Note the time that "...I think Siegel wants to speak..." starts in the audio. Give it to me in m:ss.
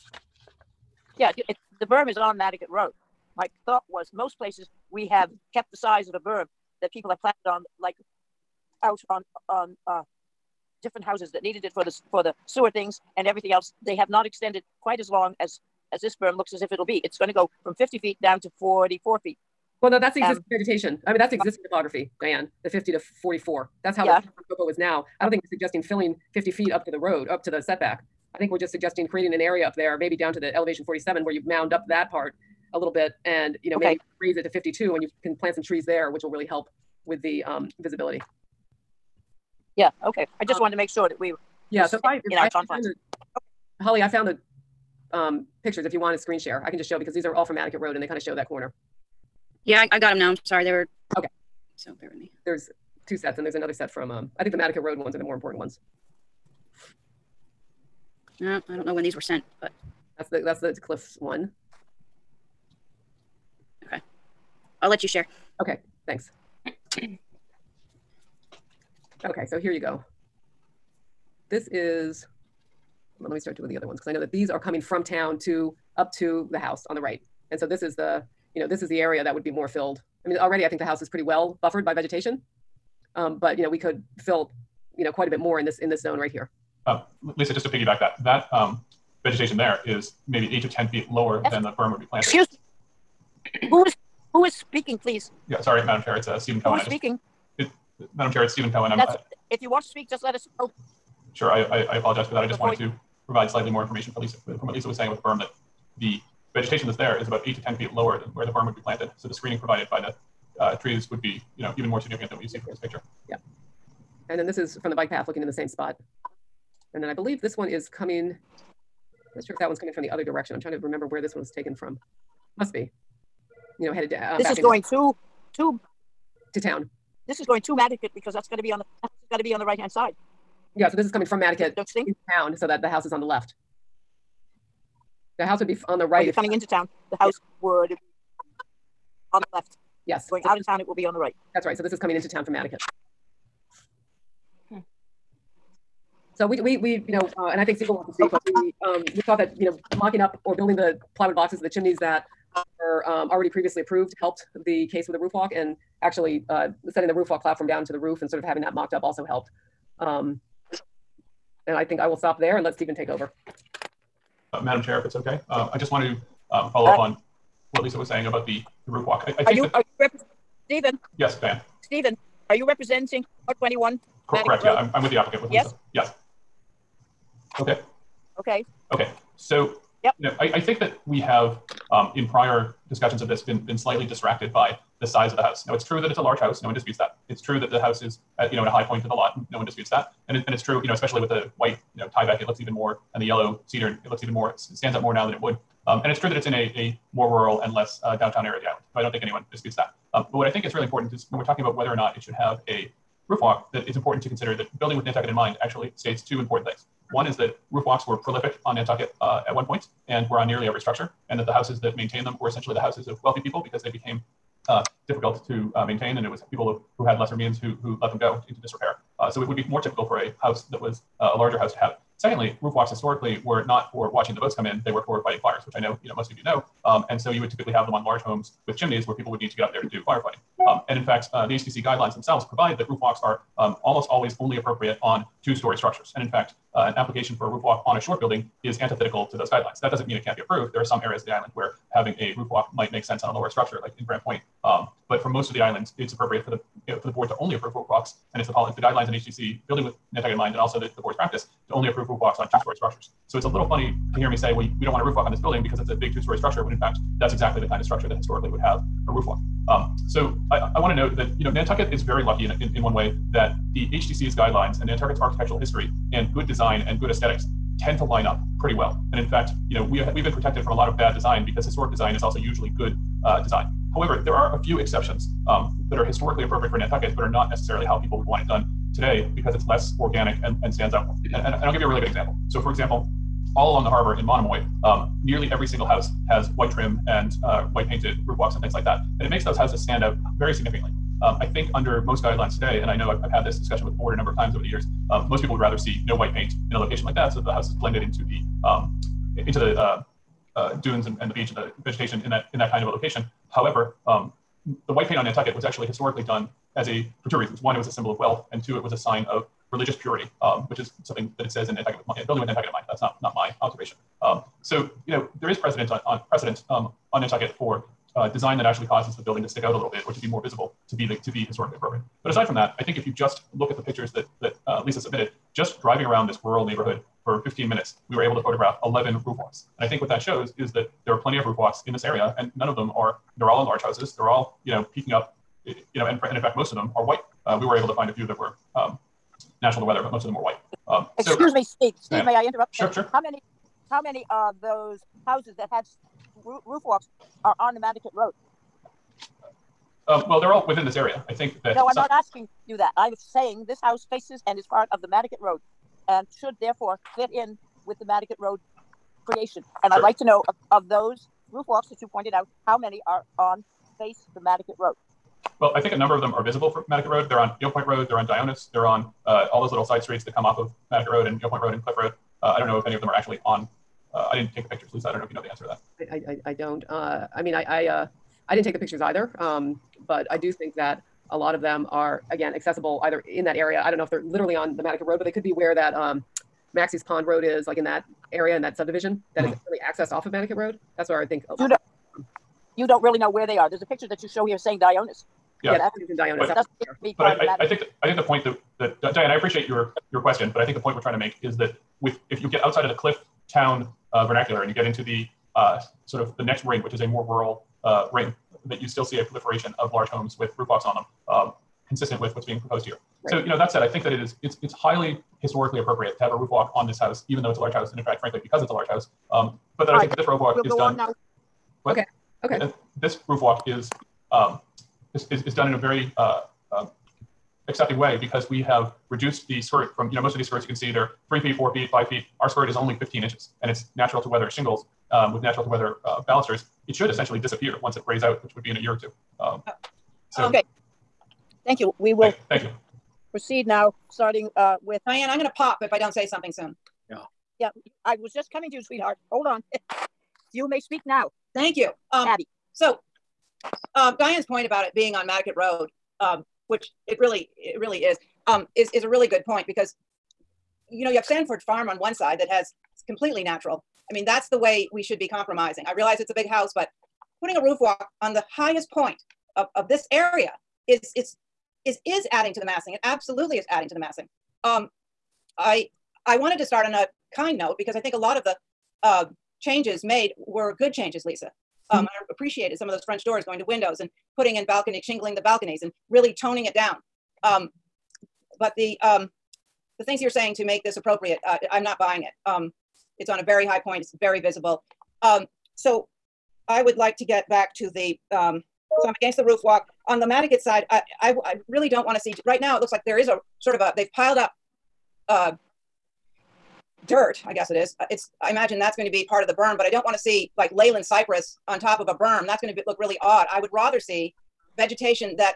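2:27.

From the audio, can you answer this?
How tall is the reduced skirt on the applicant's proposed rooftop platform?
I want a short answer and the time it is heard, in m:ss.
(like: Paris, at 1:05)
15 inches, at 7:12.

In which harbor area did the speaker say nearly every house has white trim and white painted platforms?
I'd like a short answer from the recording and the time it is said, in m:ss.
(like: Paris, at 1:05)
Monomoy, at 4:44.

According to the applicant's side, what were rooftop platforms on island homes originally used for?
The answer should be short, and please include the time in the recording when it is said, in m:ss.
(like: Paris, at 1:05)
fighting fires, at 3:45.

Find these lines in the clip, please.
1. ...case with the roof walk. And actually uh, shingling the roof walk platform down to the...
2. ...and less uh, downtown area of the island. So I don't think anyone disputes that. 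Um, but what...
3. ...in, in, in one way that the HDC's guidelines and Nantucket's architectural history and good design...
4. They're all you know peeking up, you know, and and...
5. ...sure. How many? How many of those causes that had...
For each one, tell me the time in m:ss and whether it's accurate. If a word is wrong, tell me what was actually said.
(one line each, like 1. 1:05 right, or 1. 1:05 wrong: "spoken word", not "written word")
1. 2:34 wrong: "setting", not "shingling"
2. 3:17 right
3. 4:22 right
4. 5:34 right
5. 5:42 wrong: "houses", not "causes".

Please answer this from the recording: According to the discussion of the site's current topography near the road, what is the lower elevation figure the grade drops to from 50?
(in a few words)
44 feet.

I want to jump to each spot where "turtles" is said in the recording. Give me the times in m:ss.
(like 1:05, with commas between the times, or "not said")
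not said.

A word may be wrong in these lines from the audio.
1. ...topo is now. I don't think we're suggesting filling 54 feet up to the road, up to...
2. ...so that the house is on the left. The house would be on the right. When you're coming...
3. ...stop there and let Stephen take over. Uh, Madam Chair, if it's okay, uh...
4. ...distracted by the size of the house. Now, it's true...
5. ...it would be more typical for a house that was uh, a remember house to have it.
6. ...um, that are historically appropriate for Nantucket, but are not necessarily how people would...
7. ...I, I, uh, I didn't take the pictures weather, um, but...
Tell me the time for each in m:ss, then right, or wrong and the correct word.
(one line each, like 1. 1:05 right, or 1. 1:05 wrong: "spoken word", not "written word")
1. 0:24 wrong: "50", not "54"
2. 2:12 right
3. 2:42 right
4. 3:04 right
5. 3:39 wrong: "larger", not "remember"
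6. 4:35 right
7. 6:17 wrong: "either", not "weather".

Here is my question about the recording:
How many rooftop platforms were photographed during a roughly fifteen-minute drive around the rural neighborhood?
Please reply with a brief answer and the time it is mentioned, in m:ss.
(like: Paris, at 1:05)
11, at 5:28.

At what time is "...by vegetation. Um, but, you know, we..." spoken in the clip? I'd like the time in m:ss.
1:21.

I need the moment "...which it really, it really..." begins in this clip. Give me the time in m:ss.
7:36.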